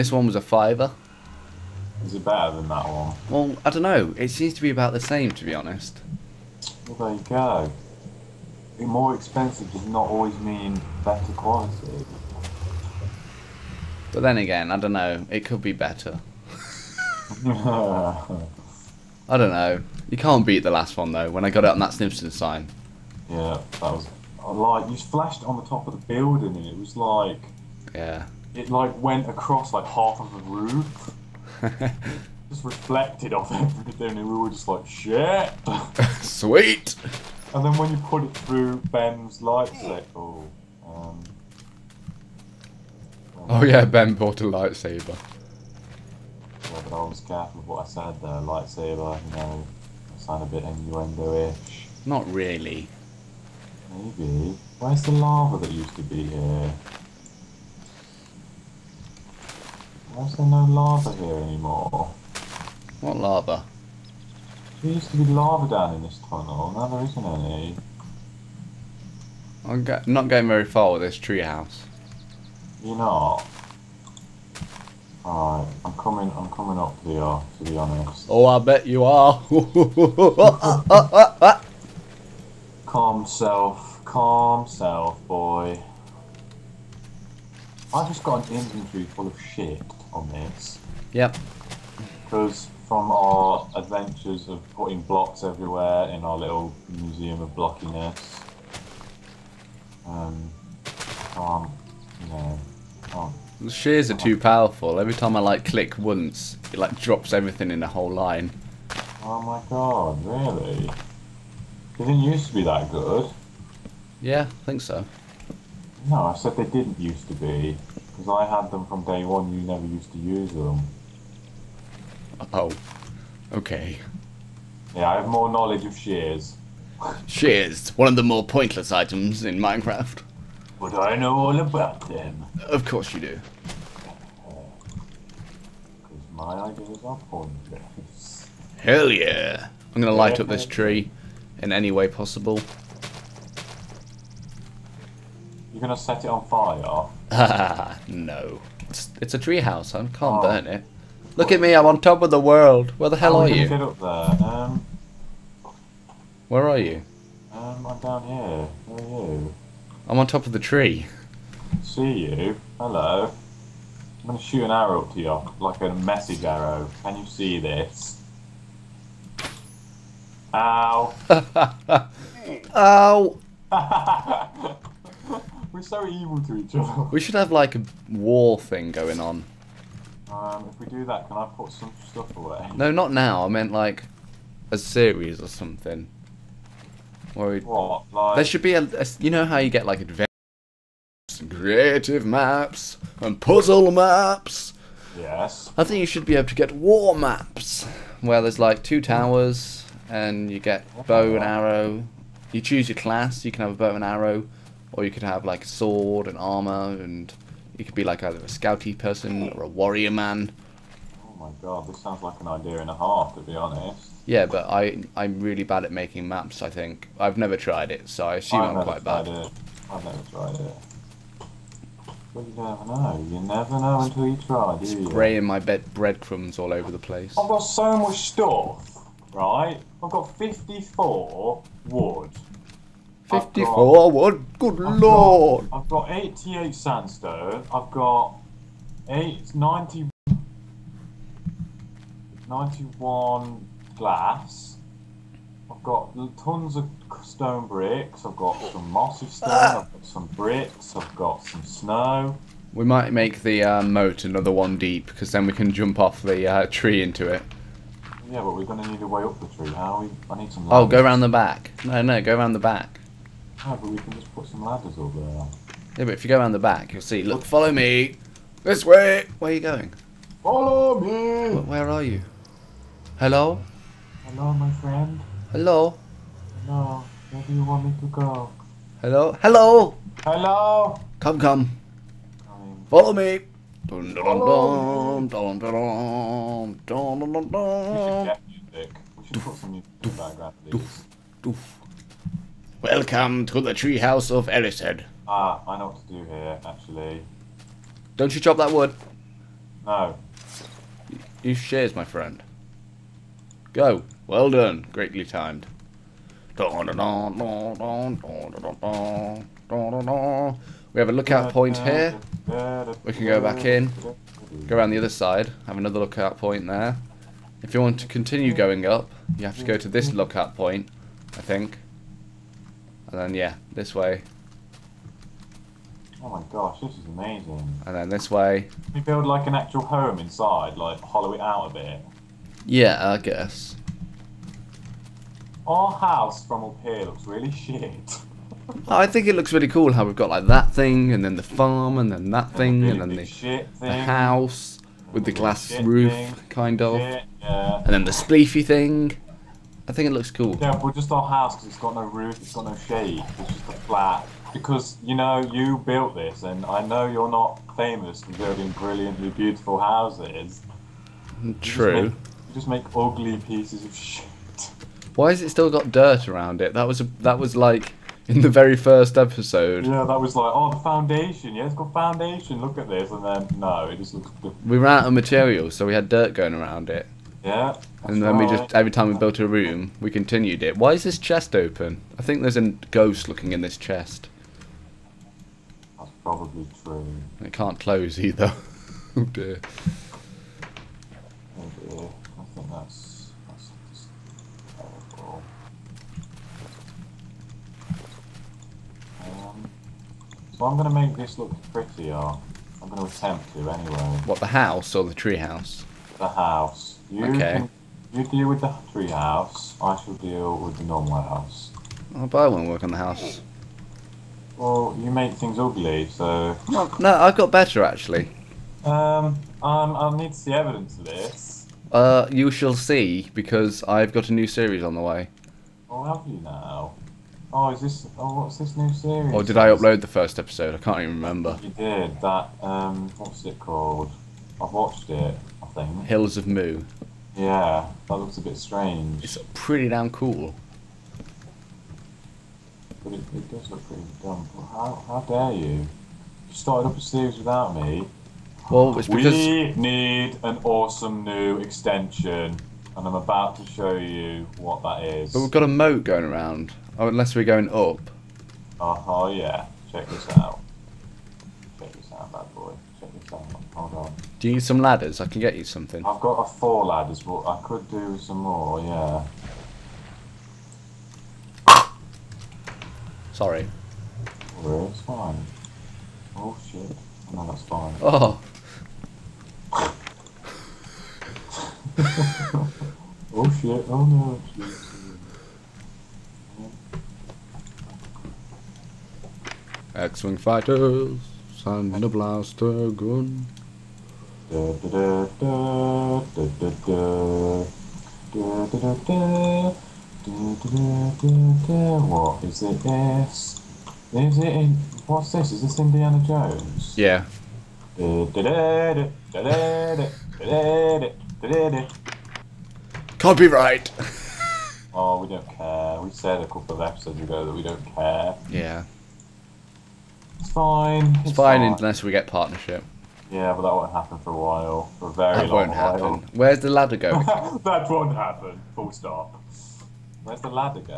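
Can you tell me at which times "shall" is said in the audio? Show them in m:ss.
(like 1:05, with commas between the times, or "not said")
6:50, 7:02.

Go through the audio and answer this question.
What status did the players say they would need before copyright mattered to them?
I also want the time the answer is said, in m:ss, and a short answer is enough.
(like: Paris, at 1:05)
Partnership, at 8:42.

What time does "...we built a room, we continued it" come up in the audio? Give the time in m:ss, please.
6:19.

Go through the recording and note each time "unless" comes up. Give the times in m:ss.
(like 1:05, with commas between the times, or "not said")
7:37, 8:41.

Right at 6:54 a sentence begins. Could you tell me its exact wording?
Well, you make things ugly, so.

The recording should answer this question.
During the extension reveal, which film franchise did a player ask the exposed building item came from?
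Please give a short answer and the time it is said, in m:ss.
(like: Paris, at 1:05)
Indiana Jones, at 8:25.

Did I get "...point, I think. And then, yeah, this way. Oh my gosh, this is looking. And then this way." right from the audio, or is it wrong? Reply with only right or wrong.
wrong.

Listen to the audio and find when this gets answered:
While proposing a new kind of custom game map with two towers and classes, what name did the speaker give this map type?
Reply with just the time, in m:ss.
3:16.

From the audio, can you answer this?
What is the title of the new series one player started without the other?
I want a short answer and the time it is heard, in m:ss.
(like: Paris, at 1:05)
Hills of Moo, at 7:16.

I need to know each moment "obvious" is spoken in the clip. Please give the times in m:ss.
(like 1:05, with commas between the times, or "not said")
not said.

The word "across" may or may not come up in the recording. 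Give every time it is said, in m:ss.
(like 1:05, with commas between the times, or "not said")
0:29.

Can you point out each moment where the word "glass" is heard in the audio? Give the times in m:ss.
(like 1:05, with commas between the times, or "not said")
4:03, 5:45.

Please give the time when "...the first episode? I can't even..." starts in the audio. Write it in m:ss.
7:10.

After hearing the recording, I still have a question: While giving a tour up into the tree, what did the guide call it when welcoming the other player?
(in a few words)
Treehouse of Erised.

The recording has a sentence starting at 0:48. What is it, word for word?
Lightsaber, you know, I sound a bit innuendo-ish.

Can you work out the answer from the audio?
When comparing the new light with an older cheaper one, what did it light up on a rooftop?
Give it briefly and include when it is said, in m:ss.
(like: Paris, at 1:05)
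Simpson sign, at 0:21.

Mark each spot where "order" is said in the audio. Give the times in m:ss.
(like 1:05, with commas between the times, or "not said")
not said.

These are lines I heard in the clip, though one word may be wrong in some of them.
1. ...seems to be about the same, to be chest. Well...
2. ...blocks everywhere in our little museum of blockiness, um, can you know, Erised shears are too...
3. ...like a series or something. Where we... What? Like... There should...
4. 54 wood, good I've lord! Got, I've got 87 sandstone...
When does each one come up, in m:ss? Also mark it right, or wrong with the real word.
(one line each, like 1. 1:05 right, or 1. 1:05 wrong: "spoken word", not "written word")
1. 0:04 wrong: "honest", not "chest"
2. 1:35 wrong: "The", not "Erised"
3. 3:03 right
4. 3:53 wrong: "88", not "87".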